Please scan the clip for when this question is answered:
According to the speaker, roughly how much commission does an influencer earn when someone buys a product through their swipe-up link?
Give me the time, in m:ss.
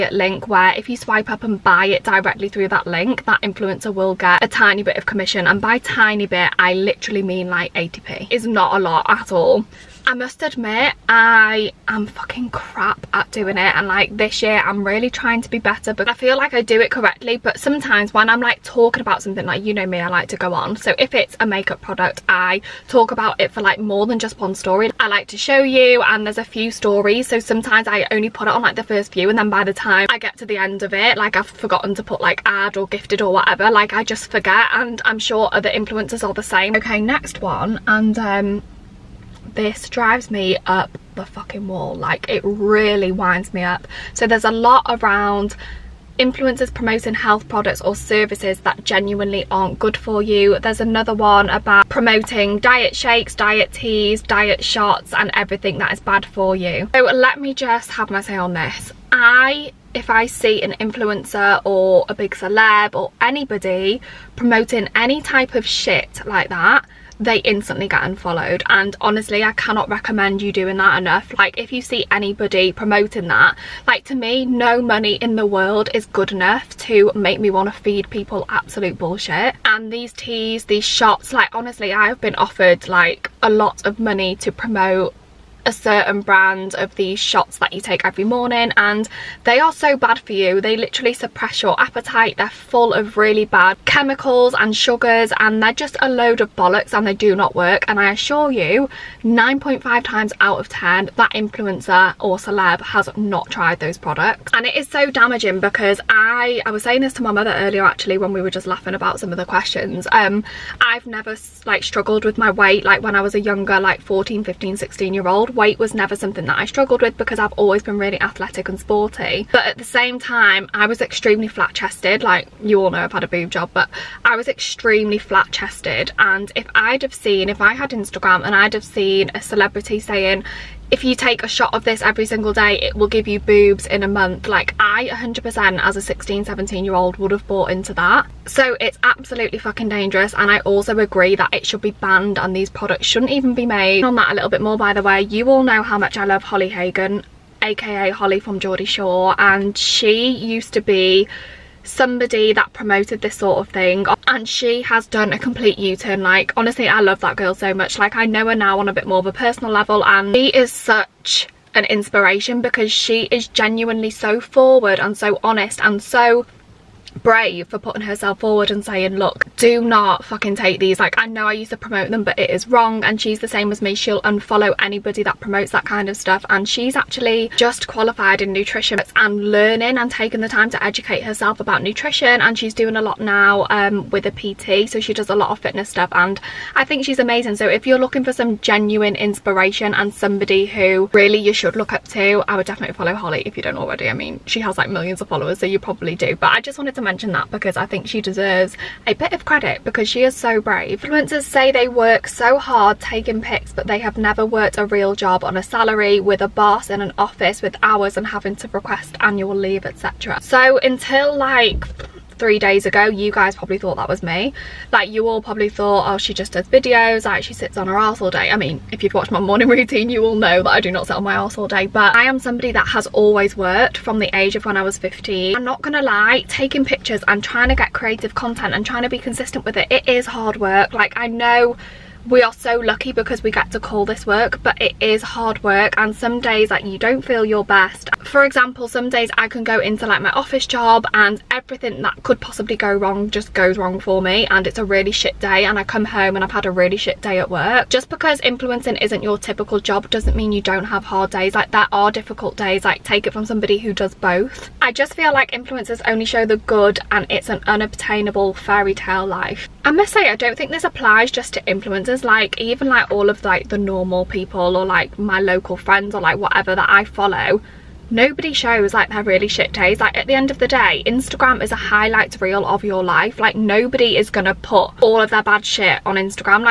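0:07.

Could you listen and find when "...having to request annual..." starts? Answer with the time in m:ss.
3:28.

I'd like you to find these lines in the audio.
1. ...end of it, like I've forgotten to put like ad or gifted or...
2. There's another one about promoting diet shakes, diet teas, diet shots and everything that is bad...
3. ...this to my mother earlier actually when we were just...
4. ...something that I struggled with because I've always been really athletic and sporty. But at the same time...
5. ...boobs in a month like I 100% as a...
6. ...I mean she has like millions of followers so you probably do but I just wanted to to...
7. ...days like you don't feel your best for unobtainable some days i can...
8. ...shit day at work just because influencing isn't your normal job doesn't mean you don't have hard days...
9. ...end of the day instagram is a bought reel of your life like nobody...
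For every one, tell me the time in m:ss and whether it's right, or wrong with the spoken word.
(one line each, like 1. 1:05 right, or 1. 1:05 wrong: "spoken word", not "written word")
1. 0:30 right
2. 0:50 right
3. 1:47 right
4. 1:56 right
5. 2:13 right
6. 3:14 right
7. 3:56 wrong: "example", not "unobtainable"
8. 4:06 wrong: "typical", not "normal"
9. 4:30 wrong: "highlight", not "bought".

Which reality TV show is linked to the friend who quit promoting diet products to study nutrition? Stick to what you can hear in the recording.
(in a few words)
Geordie Shore.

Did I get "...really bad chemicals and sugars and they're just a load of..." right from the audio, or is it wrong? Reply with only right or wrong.
right.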